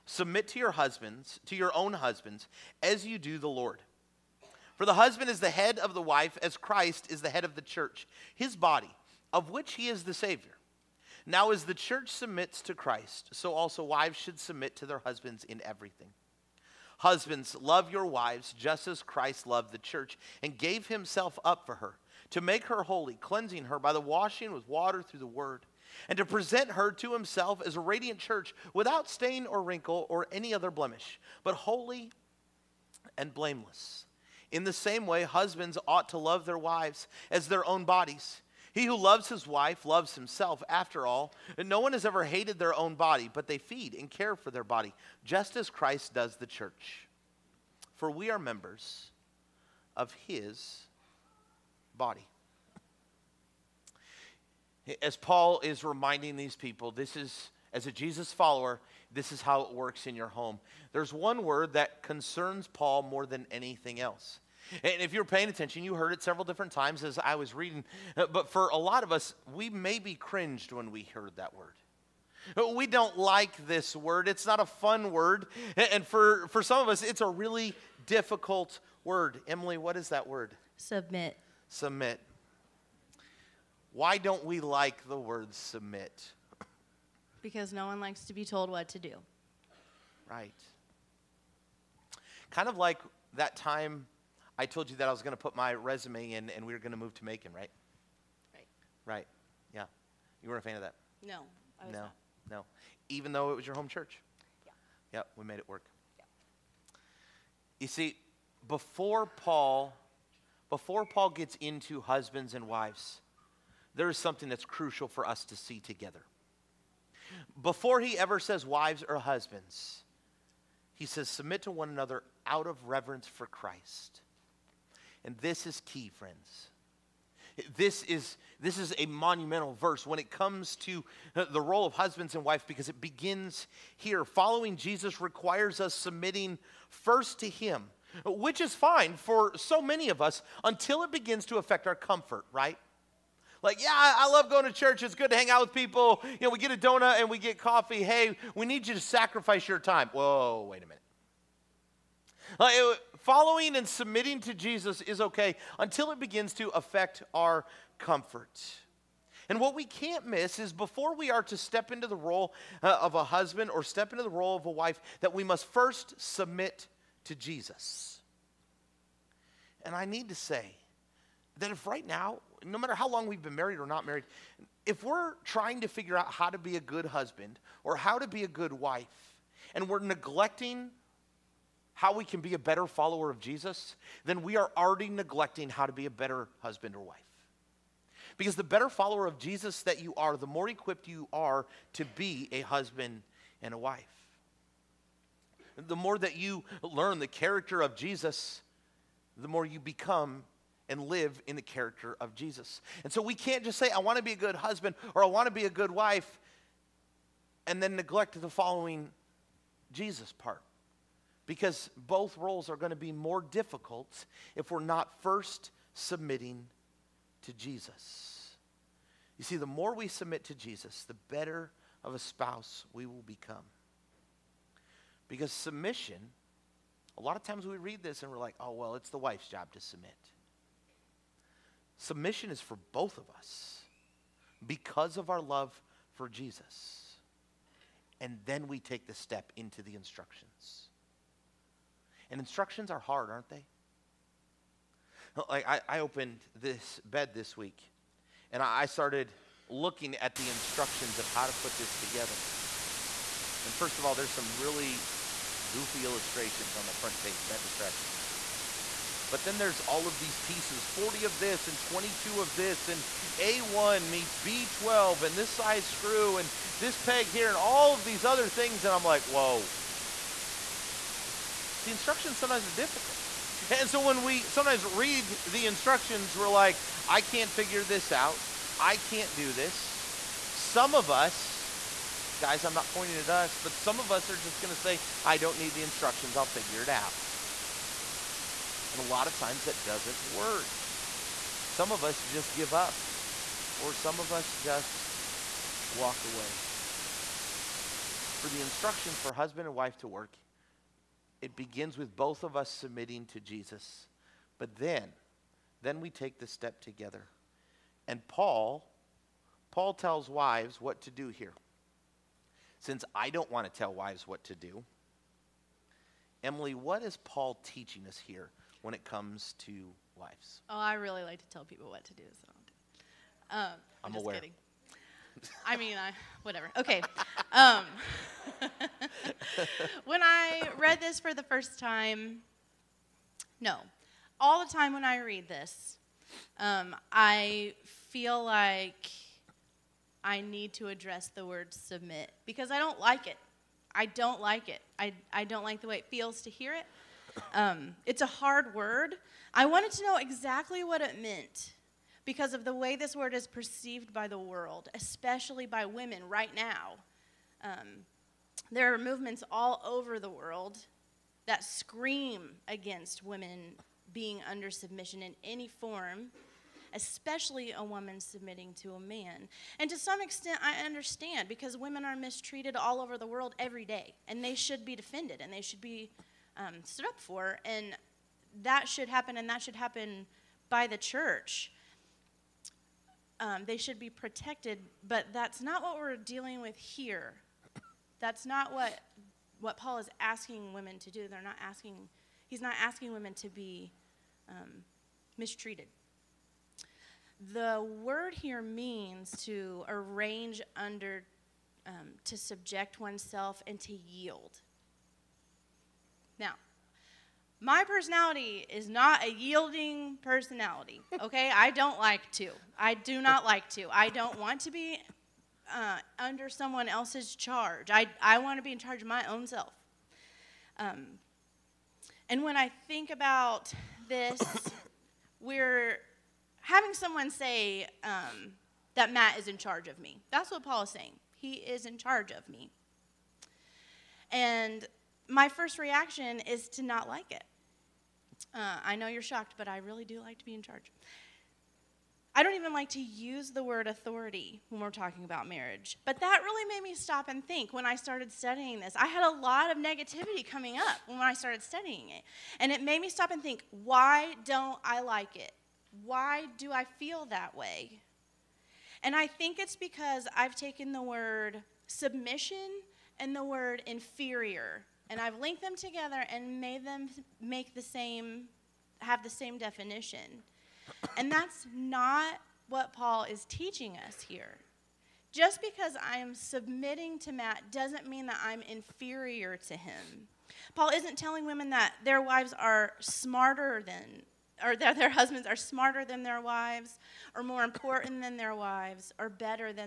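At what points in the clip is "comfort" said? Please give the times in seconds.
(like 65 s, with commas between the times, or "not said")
141 s, 157 s.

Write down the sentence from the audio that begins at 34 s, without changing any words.
In the same way, husbands ought to love their wives as their own bodies.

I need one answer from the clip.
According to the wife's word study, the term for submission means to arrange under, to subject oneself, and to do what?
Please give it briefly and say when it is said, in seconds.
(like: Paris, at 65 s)
yield, at 403 s.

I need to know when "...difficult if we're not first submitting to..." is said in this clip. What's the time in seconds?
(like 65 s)
213 s.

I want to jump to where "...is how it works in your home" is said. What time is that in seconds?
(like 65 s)
59 s.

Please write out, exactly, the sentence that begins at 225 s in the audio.
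Because submission, a lot of times we read this and we're like, oh, well, it's the wife's job to submit.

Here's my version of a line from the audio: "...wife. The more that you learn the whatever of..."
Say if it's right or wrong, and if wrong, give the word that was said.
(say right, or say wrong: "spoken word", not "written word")
wrong: "character", not "whatever".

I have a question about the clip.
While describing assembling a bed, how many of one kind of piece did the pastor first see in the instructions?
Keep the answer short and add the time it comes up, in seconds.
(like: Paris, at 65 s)
40, at 260 s.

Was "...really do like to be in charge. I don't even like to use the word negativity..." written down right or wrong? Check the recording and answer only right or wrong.
wrong.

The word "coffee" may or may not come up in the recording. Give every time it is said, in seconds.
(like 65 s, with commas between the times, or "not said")
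147 s.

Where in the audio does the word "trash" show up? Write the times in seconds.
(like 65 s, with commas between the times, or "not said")
not said.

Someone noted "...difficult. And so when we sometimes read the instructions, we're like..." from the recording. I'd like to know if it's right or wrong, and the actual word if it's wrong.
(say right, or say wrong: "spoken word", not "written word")
right.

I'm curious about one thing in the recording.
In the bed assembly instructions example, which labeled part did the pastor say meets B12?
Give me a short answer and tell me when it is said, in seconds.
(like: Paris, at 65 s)
A1, at 263 s.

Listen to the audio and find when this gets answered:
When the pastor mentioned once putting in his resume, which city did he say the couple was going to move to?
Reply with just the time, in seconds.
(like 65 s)
97 s.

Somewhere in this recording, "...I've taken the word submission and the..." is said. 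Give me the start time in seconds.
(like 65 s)
460 s.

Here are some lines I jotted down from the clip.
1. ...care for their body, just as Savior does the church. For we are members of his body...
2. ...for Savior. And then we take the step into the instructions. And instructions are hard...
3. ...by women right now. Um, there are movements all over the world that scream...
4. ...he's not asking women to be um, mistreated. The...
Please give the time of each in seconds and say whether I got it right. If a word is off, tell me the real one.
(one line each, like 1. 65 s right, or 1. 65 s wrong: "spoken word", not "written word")
1. 44 s wrong: "Christ", not "Savior"
2. 236 s wrong: "Jesus", not "Savior"
3. 355 s right
4. 392 s right.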